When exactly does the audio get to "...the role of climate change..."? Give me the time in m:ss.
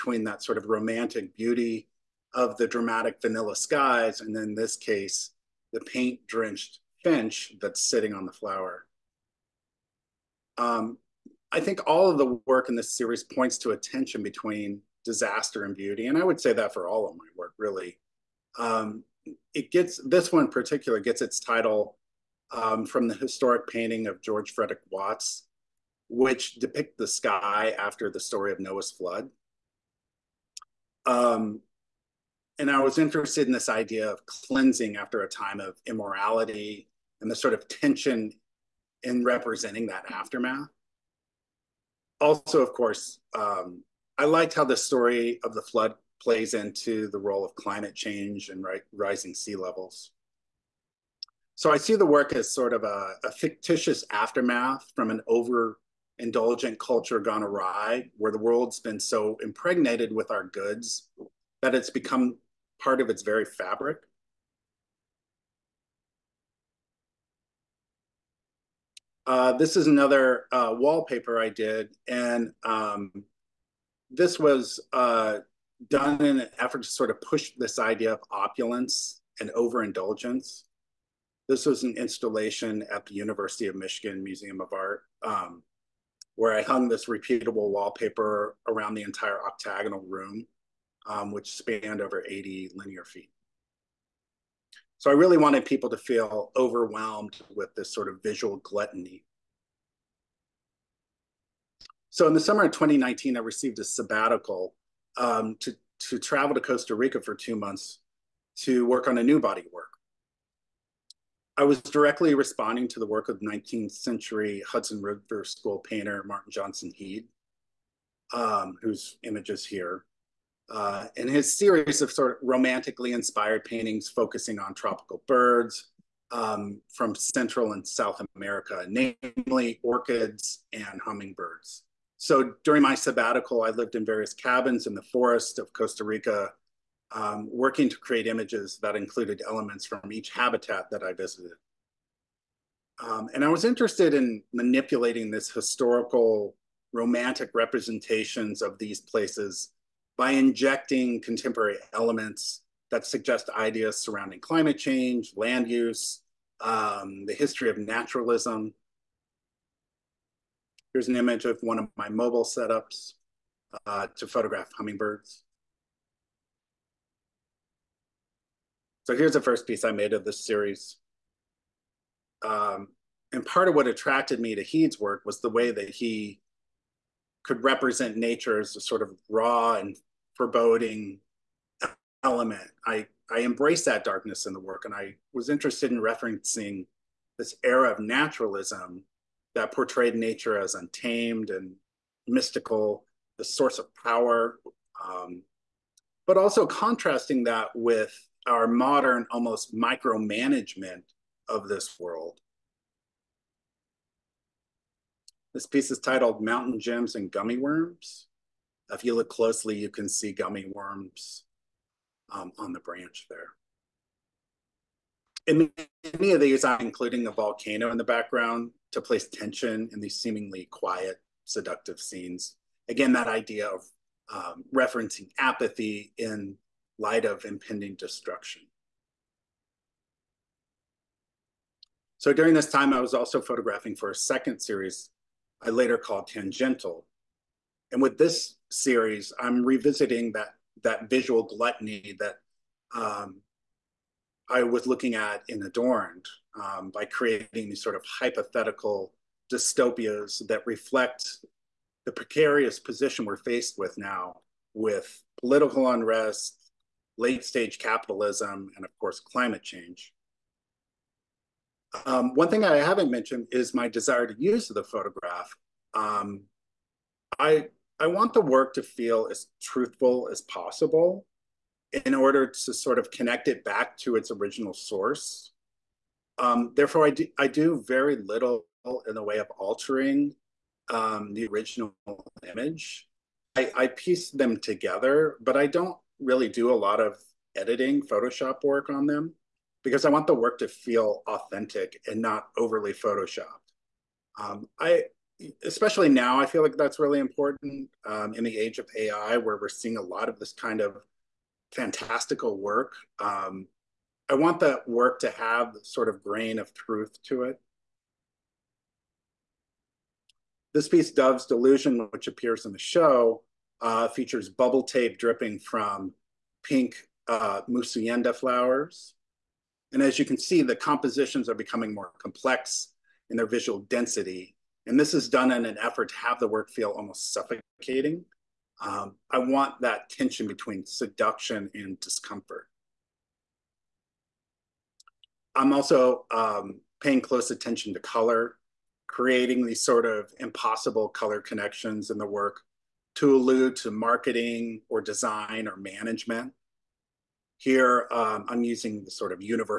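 0:47.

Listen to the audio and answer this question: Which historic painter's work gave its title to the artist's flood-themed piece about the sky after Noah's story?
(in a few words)
George Frederic Watts.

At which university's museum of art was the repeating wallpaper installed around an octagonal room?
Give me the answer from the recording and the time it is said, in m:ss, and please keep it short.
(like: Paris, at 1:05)
University of Michigan, at 1:23.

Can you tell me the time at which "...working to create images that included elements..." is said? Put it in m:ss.
2:17.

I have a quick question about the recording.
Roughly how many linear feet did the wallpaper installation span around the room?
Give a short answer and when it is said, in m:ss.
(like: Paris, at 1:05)
80, at 1:32.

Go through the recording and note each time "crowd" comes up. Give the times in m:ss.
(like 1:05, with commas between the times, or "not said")
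not said.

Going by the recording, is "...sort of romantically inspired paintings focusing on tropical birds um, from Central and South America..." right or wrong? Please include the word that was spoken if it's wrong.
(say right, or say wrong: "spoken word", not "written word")
right.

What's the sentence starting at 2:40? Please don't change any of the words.
Here's an image of one of my mobile setups uh, to photograph hummingbirds.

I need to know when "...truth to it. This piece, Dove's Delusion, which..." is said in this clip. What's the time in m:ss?
5:06.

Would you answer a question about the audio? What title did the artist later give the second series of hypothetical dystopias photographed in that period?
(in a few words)
Tangential.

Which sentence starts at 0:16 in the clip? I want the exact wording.
And I would say that for all of my work, really.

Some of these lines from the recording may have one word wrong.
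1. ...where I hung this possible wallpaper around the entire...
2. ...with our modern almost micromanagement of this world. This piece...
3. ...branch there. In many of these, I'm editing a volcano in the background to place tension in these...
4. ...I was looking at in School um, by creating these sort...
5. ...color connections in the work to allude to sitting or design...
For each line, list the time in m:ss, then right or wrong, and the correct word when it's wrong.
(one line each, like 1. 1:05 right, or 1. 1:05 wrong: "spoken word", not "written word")
1. 1:26 wrong: "repeatable", not "possible"
2. 3:17 right
3. 3:32 wrong: "including", not "editing"
4. 4:04 wrong: "Adorned", not "School"
5. 5:41 wrong: "marketing", not "sitting".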